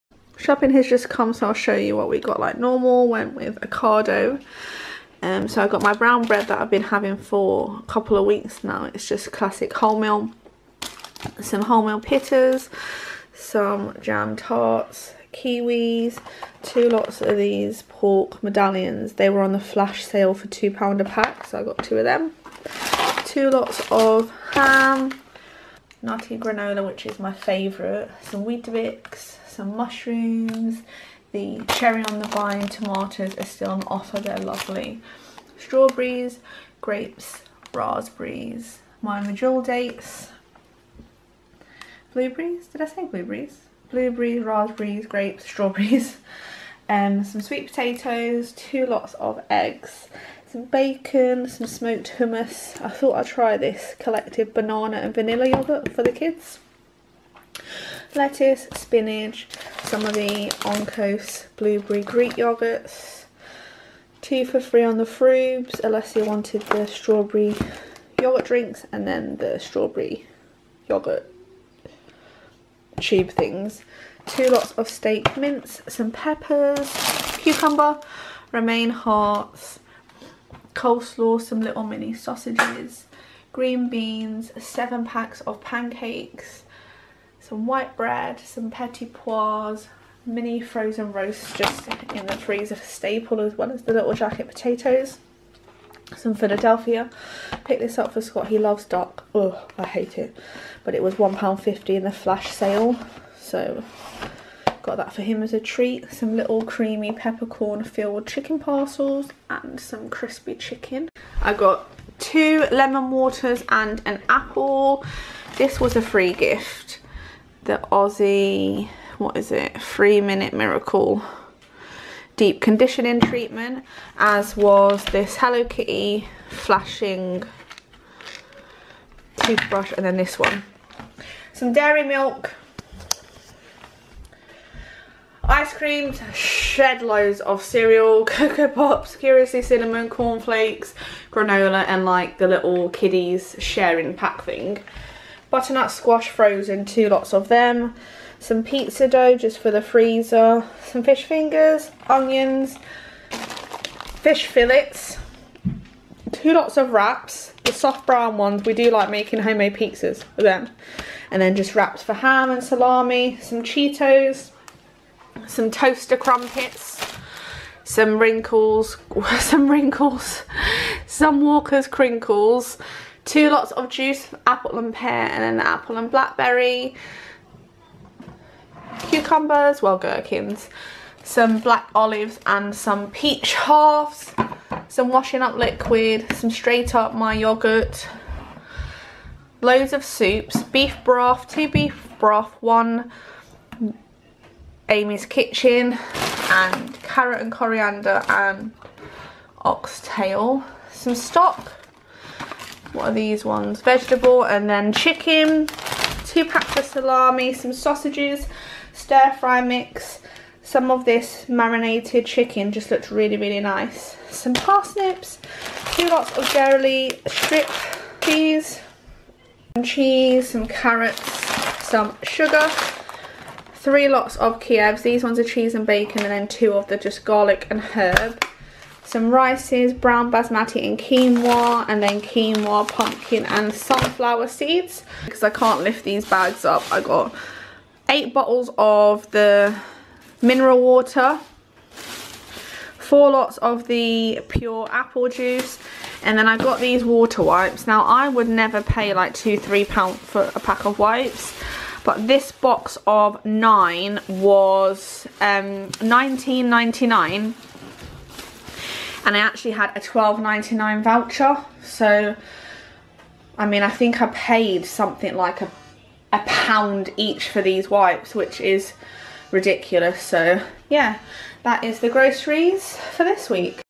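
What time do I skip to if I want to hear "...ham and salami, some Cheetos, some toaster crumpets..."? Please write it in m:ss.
2:42.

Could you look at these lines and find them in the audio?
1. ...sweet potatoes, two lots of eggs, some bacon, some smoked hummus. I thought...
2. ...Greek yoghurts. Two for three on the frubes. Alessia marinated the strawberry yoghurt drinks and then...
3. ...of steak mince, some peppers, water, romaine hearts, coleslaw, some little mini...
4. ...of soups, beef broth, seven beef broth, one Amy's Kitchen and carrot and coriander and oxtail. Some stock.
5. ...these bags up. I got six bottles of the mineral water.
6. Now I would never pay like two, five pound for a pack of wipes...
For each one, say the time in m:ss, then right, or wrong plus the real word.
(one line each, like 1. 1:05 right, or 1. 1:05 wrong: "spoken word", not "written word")
1. 0:47 right
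2. 1:02 wrong: "wanted", not "marinated"
3. 1:14 wrong: "cucumber", not "water"
4. 3:09 wrong: "two", not "seven"
5. 3:56 wrong: "eight", not "six"
6. 4:07 wrong: "three", not "five".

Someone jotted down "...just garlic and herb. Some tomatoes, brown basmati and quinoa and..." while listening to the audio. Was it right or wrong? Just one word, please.
wrong.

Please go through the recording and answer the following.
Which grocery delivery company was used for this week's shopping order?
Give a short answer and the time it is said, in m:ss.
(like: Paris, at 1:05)
Ocado, at 0:03.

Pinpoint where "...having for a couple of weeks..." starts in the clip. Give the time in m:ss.
0:06.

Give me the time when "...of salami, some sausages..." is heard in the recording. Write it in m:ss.
3:26.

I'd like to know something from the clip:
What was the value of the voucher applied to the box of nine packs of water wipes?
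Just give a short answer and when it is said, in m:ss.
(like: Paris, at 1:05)
£12.99, at 4:19.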